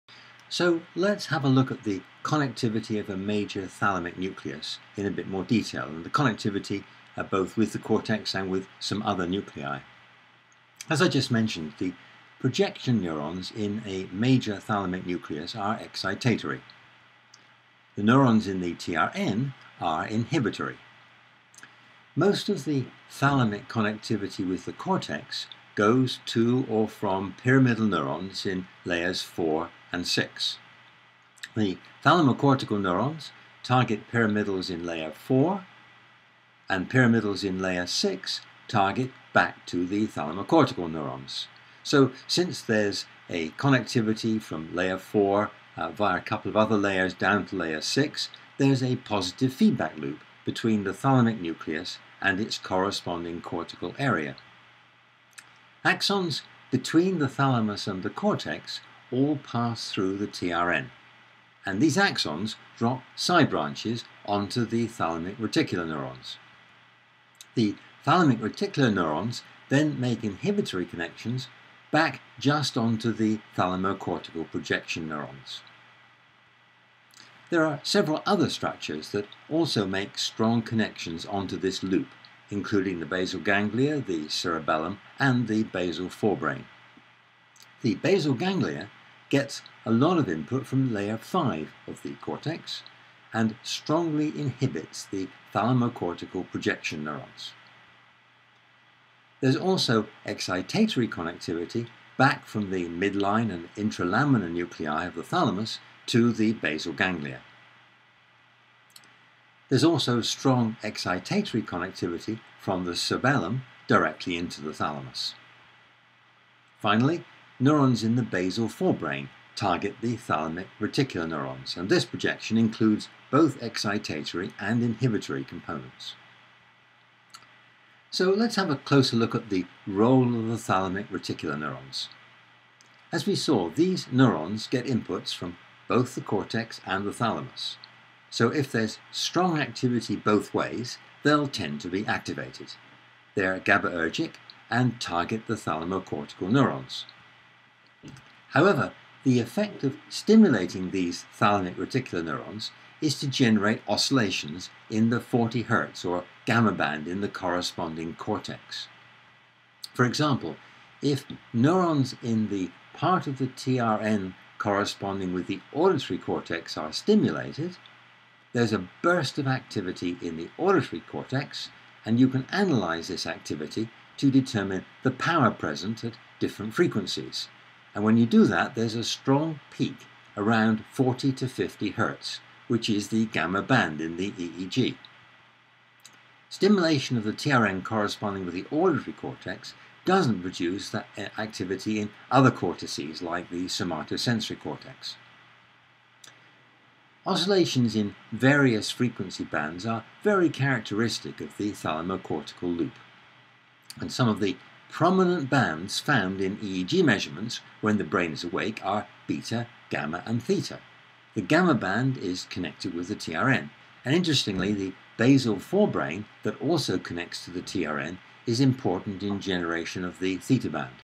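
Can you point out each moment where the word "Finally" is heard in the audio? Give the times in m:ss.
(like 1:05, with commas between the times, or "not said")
1:56.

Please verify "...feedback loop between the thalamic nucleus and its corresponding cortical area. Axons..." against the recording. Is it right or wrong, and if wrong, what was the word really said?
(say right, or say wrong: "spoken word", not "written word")
right.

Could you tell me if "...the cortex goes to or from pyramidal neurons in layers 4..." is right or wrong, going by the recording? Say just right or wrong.
right.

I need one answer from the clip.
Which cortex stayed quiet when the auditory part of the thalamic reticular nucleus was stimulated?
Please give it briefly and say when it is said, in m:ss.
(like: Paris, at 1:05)
Somatosensory cortex, at 3:13.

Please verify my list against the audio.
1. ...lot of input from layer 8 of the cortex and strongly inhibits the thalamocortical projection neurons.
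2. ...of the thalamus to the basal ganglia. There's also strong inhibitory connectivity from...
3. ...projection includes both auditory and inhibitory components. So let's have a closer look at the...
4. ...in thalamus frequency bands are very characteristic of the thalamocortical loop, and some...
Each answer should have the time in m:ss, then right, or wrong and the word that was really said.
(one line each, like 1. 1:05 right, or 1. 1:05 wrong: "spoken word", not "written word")
1. 1:29 wrong: "5", not "8"
2. 1:45 wrong: "excitatory", not "inhibitory"
3. 2:02 wrong: "excitatory", not "auditory"
4. 3:17 wrong: "various", not "thalamus".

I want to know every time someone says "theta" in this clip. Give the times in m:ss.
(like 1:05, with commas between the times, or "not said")
3:30, 3:40.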